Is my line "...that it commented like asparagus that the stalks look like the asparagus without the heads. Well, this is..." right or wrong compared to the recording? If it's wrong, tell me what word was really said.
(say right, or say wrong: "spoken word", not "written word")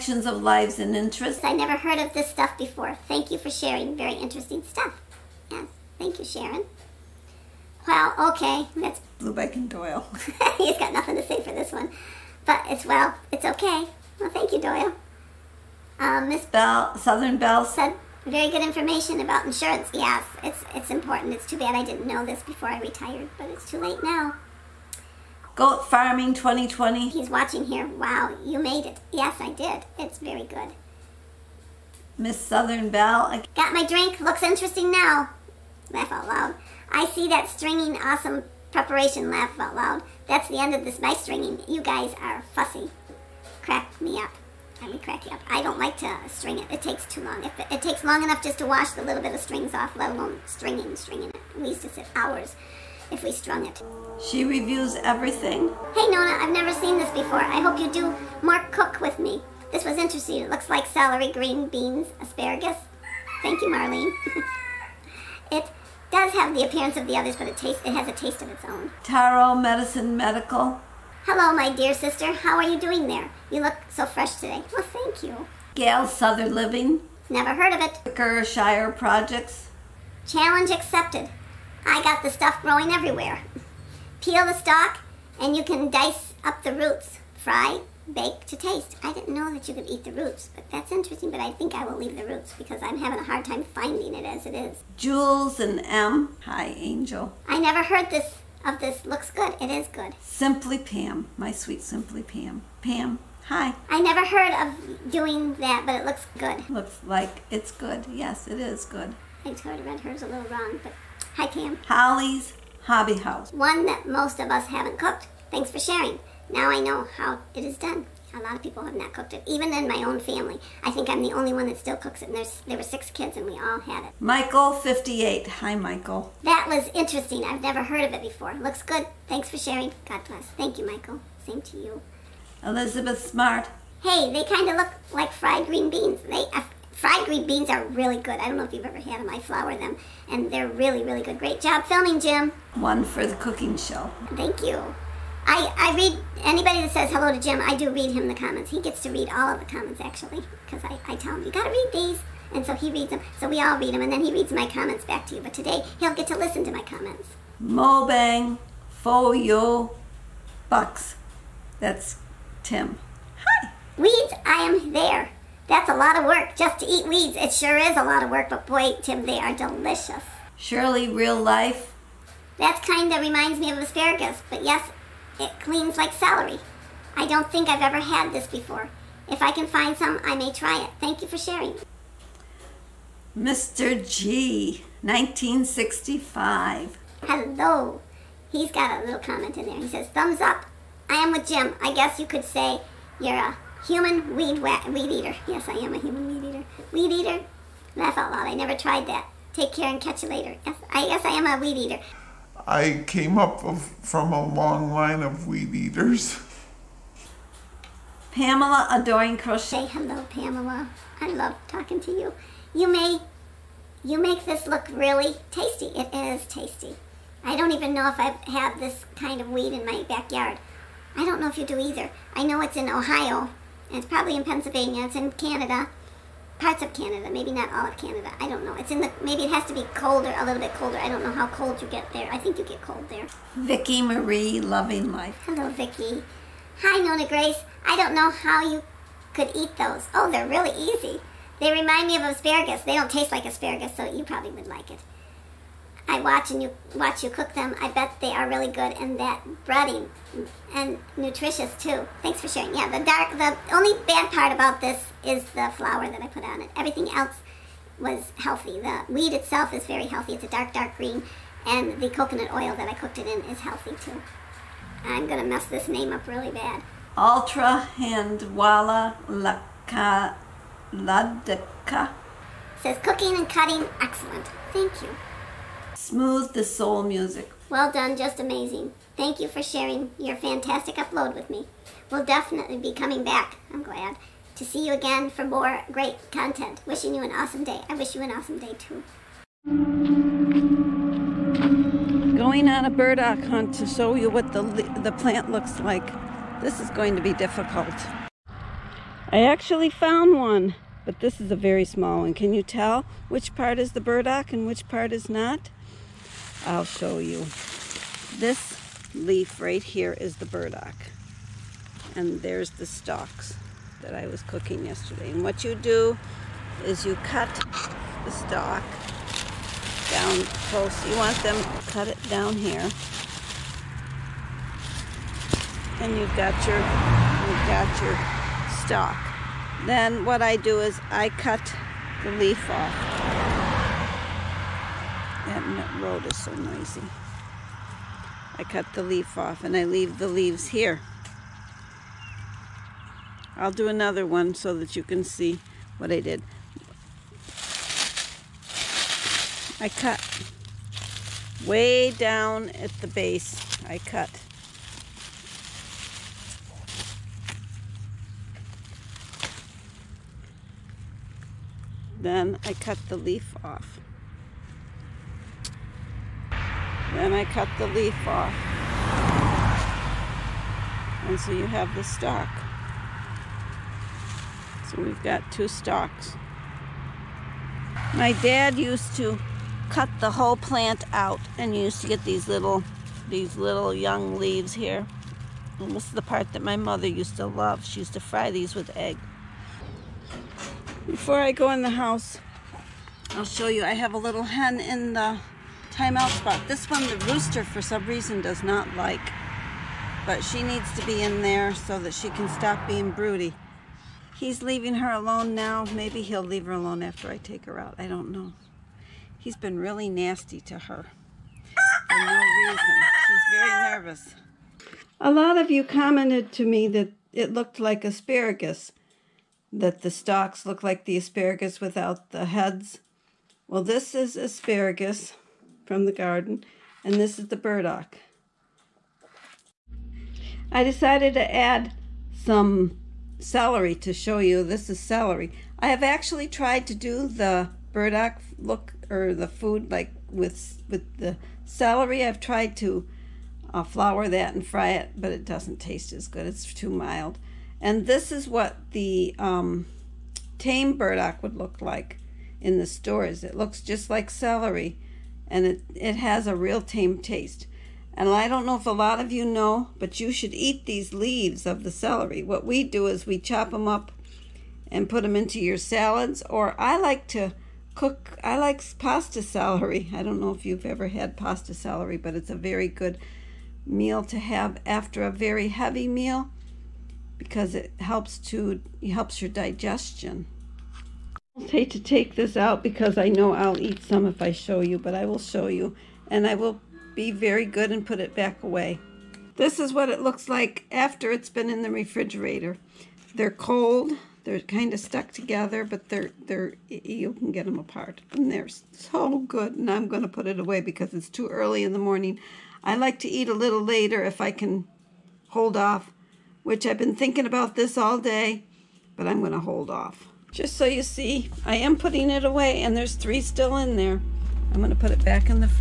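wrong: "looked", not "commented".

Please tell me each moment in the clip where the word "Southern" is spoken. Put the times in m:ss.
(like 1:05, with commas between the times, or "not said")
0:16, 0:32, 1:16.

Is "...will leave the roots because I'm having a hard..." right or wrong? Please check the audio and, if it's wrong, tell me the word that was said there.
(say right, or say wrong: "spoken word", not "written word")
right.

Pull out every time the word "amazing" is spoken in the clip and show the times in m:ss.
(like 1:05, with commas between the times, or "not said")
4:38.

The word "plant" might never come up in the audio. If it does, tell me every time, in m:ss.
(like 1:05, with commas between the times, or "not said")
4:55, 6:20.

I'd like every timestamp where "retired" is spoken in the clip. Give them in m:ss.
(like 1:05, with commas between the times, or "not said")
0:22.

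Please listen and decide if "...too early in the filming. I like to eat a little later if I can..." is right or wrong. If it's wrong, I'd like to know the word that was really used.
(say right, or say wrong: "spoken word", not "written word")
wrong: "morning", not "filming".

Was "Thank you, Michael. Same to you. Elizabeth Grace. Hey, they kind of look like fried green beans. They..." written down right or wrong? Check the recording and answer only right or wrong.
wrong.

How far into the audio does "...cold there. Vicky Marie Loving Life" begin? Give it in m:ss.
3:52.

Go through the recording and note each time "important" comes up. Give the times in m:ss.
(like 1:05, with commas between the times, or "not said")
0:20.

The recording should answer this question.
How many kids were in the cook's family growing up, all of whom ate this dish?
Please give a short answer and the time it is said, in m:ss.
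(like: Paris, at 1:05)
6, at 2:02.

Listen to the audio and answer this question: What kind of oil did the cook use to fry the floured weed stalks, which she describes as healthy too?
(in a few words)
coconut oil.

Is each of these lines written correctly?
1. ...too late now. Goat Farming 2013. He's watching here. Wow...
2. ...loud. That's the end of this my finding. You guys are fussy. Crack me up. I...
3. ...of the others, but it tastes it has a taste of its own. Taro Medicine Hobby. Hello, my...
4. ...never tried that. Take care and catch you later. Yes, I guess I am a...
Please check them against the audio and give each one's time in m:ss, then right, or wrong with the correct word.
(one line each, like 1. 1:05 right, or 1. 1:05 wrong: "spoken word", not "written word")
1. 0:23 wrong: "2020", not "2013"
2. 0:39 wrong: "stringing", not "finding"
3. 1:06 wrong: "Medical", not "Hobby"
4. 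3:18 right.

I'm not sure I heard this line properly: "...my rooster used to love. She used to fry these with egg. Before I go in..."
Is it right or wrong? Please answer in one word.
wrong.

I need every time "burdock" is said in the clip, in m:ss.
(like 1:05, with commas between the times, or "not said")
4:52, 5:04, 5:10, 7:07, 7:17, 7:30.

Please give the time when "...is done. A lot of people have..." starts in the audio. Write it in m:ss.
1:57.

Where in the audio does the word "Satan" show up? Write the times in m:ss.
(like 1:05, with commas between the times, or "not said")
not said.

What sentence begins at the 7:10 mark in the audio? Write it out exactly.
I decided to add some celery to show you.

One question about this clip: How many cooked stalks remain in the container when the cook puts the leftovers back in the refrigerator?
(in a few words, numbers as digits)
3.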